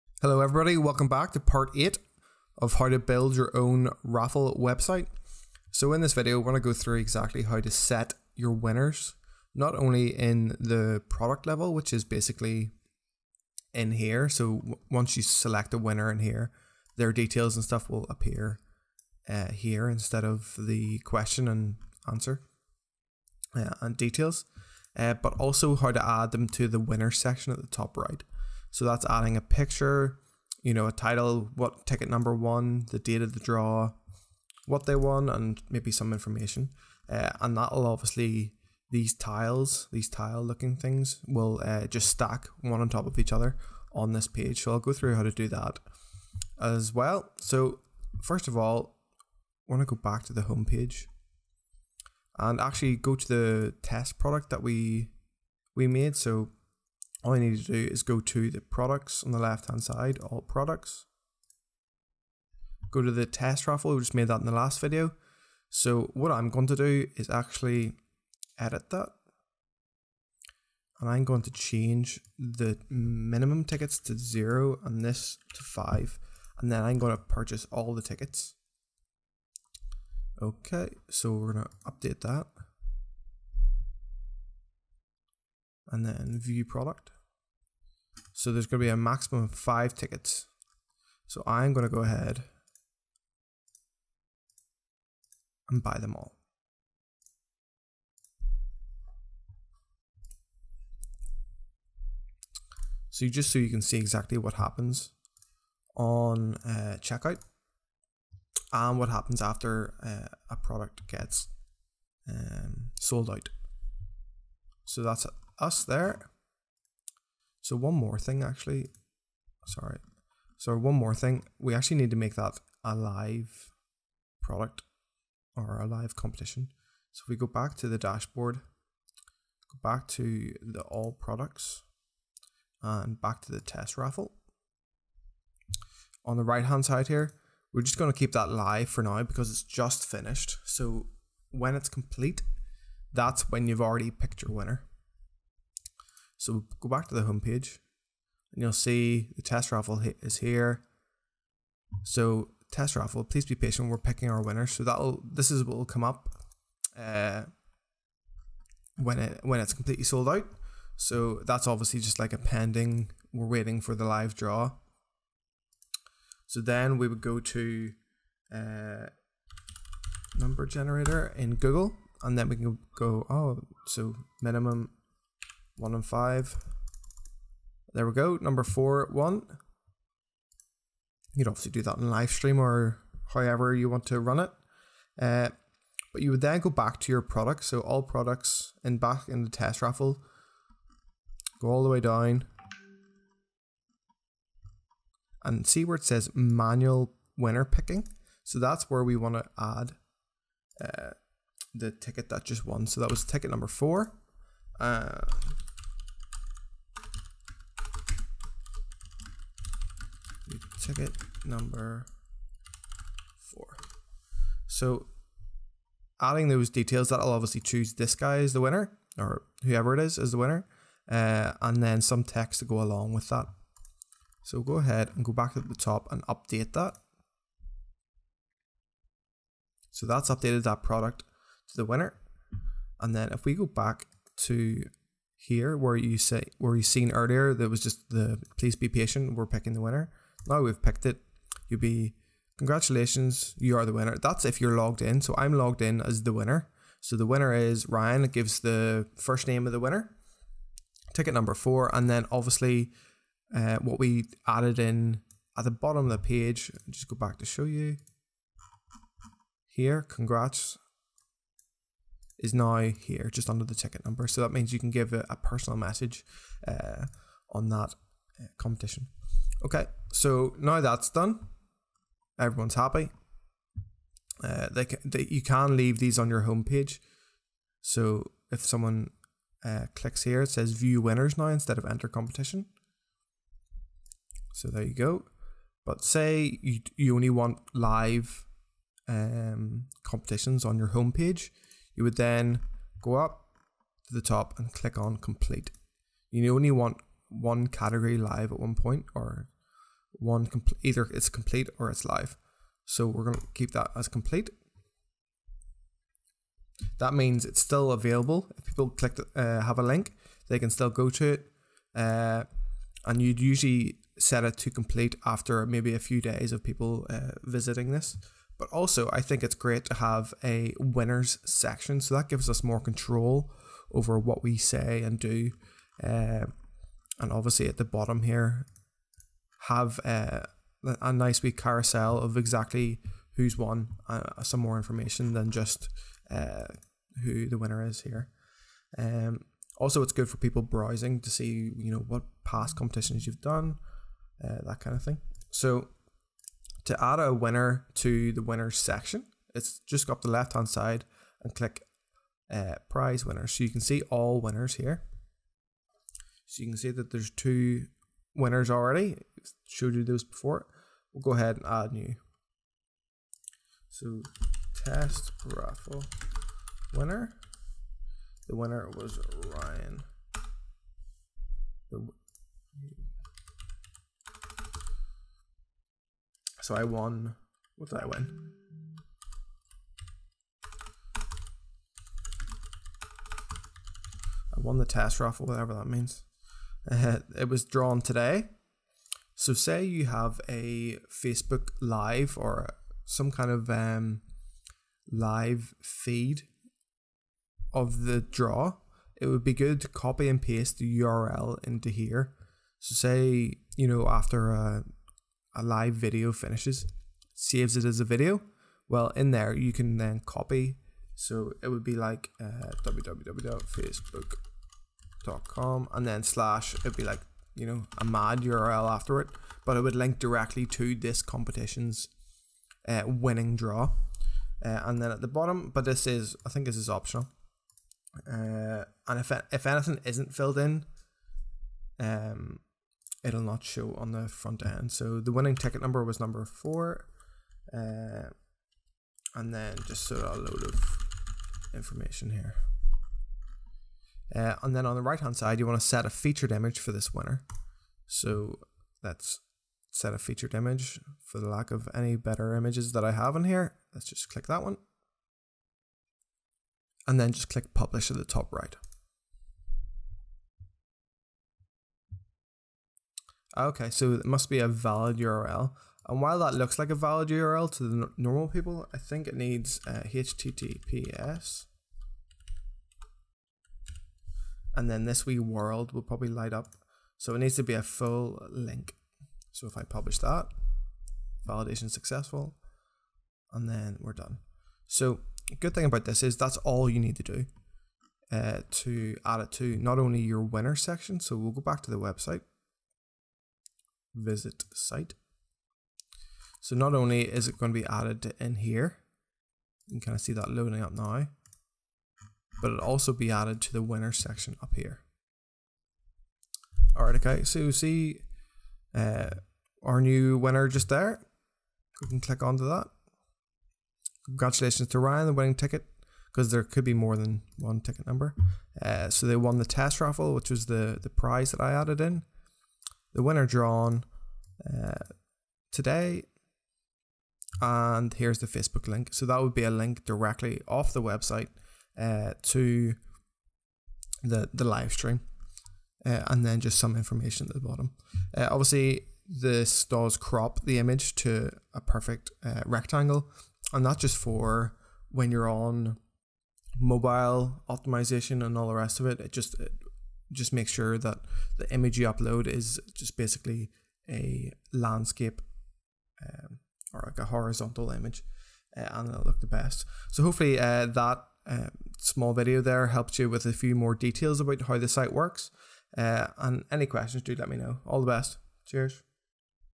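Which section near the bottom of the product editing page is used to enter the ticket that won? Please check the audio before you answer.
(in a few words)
Manual winner picking.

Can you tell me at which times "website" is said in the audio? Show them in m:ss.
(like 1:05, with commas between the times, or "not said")
0:04, 8:11, 8:51.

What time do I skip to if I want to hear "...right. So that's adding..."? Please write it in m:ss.
0:27.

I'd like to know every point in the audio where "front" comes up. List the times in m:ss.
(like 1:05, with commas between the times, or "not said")
7:14.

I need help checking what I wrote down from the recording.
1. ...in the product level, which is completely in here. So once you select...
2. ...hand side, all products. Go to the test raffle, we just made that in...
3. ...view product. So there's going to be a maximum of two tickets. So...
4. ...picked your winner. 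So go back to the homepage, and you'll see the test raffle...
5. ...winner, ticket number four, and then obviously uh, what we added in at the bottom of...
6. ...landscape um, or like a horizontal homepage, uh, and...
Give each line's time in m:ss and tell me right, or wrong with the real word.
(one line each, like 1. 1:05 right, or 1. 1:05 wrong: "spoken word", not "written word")
1. 0:10 wrong: "basically", not "completely"
2. 0:59 right
3. 1:26 wrong: "five", not "two"
4. 2:24 right
5. 4:09 right
6. 9:14 wrong: "image", not "homepage".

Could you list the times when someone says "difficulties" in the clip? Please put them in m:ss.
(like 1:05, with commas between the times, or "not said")
not said.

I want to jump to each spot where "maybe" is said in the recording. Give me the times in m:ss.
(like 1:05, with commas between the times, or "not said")
0:35, 5:15.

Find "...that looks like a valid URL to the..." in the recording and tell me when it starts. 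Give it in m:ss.
7:46.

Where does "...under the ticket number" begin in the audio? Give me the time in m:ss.
4:23.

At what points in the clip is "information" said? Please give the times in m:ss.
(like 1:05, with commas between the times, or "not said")
0:36, 5:34, 7:21, 8:56.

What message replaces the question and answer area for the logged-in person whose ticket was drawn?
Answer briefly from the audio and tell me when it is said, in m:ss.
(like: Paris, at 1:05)
Congratulations, you are the winner, at 4:02.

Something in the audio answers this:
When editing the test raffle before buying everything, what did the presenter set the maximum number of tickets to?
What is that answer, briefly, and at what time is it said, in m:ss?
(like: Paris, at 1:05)
5, at 1:15.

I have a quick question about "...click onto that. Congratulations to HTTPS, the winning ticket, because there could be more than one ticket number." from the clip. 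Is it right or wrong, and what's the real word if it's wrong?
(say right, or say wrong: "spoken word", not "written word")
wrong: "Ryan", not "HTTPS".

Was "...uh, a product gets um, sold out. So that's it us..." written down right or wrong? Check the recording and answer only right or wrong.
right.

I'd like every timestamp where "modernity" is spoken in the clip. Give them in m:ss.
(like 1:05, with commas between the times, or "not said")
not said.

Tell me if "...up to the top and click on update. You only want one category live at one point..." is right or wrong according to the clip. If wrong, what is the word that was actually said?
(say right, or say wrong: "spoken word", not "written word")
wrong: "complete", not "update".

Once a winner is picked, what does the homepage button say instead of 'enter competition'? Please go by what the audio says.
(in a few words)
View winners.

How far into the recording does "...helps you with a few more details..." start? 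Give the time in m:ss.
9:22.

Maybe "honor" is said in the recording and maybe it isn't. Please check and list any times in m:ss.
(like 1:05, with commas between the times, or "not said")
not said.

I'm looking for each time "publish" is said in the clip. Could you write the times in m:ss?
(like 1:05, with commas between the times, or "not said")
7:37, 7:59.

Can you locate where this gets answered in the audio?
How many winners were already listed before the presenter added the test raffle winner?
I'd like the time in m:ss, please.
5:57.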